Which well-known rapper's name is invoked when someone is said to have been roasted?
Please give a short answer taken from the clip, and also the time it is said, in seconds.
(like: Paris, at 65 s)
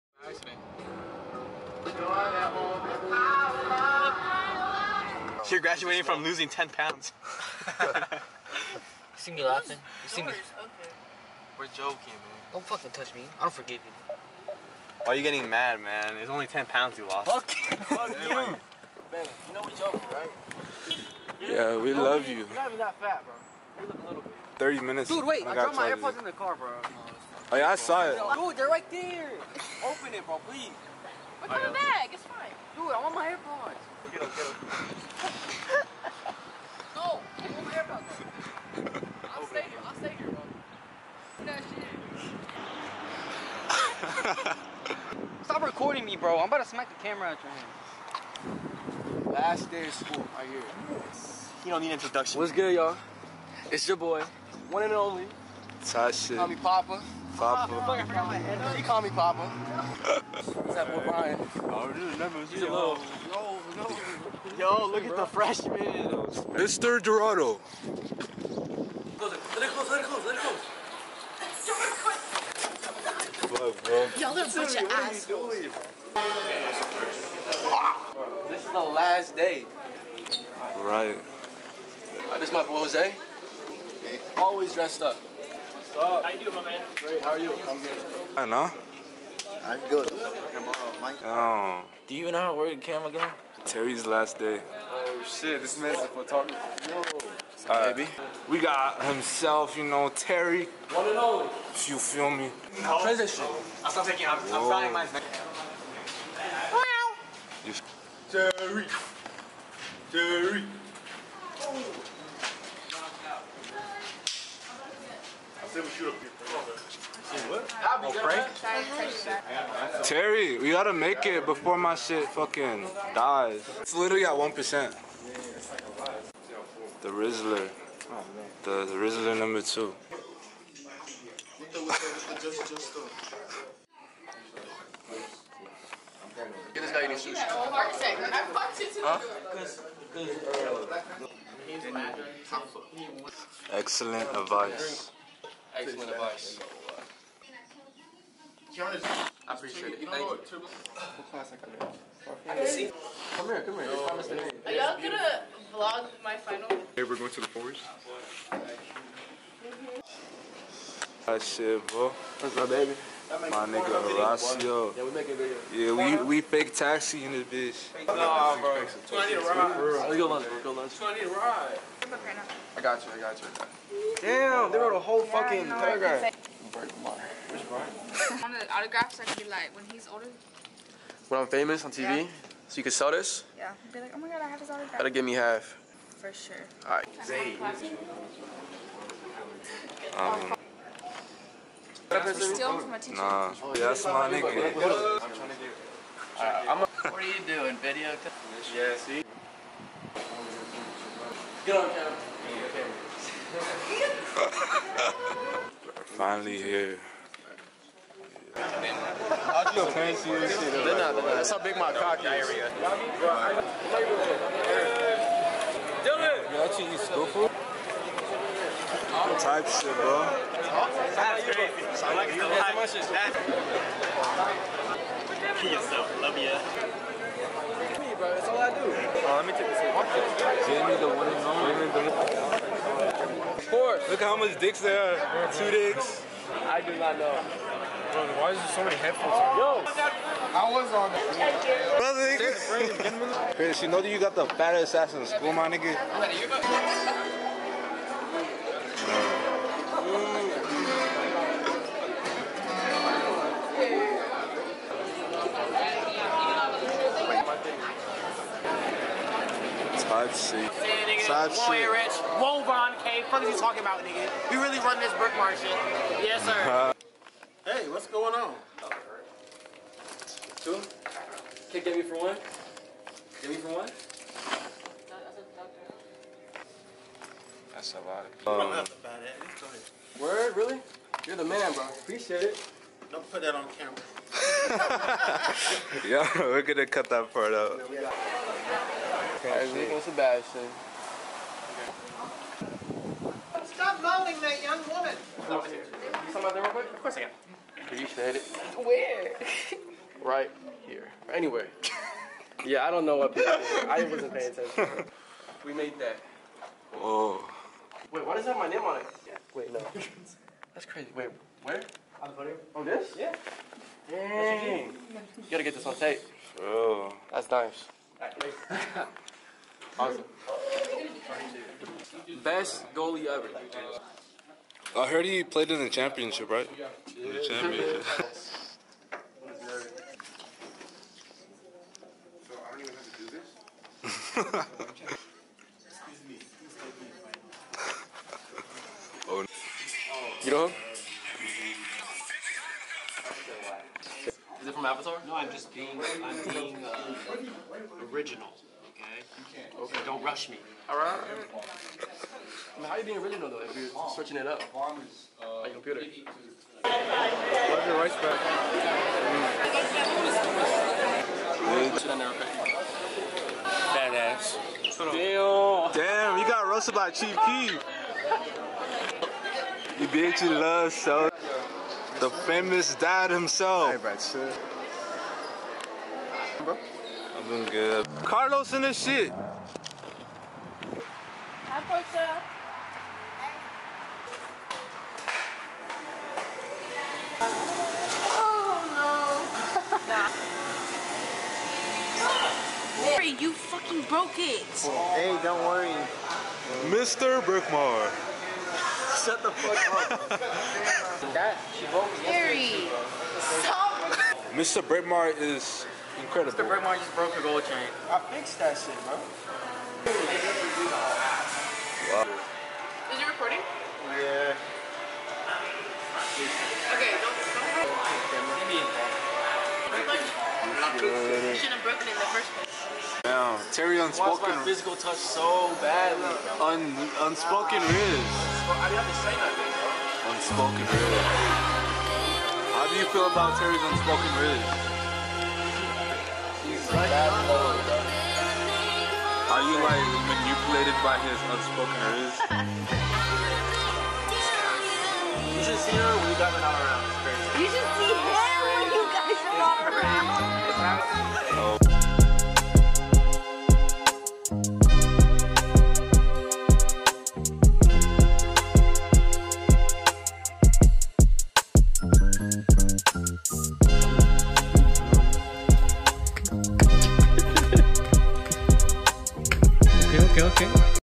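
Chief Keef, at 367 s.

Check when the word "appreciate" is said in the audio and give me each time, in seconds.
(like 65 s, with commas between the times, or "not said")
149 s, 281 s.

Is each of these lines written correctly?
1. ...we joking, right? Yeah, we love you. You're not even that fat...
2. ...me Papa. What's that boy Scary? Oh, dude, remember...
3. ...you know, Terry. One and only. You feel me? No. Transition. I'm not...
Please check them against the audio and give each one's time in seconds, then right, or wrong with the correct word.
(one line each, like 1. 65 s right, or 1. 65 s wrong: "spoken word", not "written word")
1. 19 s right
2. 59 s wrong: "Brian", not "Scary"
3. 99 s right.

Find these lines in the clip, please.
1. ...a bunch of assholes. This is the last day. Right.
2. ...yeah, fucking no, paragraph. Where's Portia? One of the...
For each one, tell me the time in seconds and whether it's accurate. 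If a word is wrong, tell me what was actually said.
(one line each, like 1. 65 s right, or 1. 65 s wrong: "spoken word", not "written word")
1. 74 s right
2. 175 s wrong: "Brian", not "Portia".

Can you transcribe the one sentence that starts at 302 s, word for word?
yeah, I don't know what people I wasn't paying attention.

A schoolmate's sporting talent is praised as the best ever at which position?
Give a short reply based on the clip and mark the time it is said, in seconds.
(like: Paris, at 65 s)
Goalie, at 322 s.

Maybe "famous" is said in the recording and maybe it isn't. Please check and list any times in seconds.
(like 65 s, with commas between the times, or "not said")
181 s, 372 s.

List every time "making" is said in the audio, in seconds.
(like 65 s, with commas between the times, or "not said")
165 s.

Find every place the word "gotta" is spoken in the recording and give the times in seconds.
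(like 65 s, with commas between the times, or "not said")
120 s, 315 s.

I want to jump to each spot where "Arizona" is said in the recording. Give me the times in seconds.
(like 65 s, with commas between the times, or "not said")
not said.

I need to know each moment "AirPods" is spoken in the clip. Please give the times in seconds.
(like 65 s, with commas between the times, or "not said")
25 s, 33 s, 37 s.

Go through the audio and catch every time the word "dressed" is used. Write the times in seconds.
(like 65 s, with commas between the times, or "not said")
84 s.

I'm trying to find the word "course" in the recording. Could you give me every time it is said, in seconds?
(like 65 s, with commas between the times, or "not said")
233 s, 297 s.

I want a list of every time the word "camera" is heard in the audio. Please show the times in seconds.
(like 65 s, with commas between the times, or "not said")
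47 s, 92 s, 201 s, 283 s.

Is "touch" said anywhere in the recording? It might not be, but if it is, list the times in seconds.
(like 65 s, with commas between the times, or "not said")
12 s, 424 s.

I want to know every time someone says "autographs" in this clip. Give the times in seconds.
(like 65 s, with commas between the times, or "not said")
178 s, 184 s.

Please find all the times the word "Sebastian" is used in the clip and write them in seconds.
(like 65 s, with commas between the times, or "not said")
290 s.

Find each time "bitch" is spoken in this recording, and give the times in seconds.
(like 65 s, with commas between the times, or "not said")
167 s, 370 s.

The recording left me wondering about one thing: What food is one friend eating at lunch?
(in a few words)
Sushi.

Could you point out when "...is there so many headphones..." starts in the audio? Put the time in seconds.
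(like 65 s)
238 s.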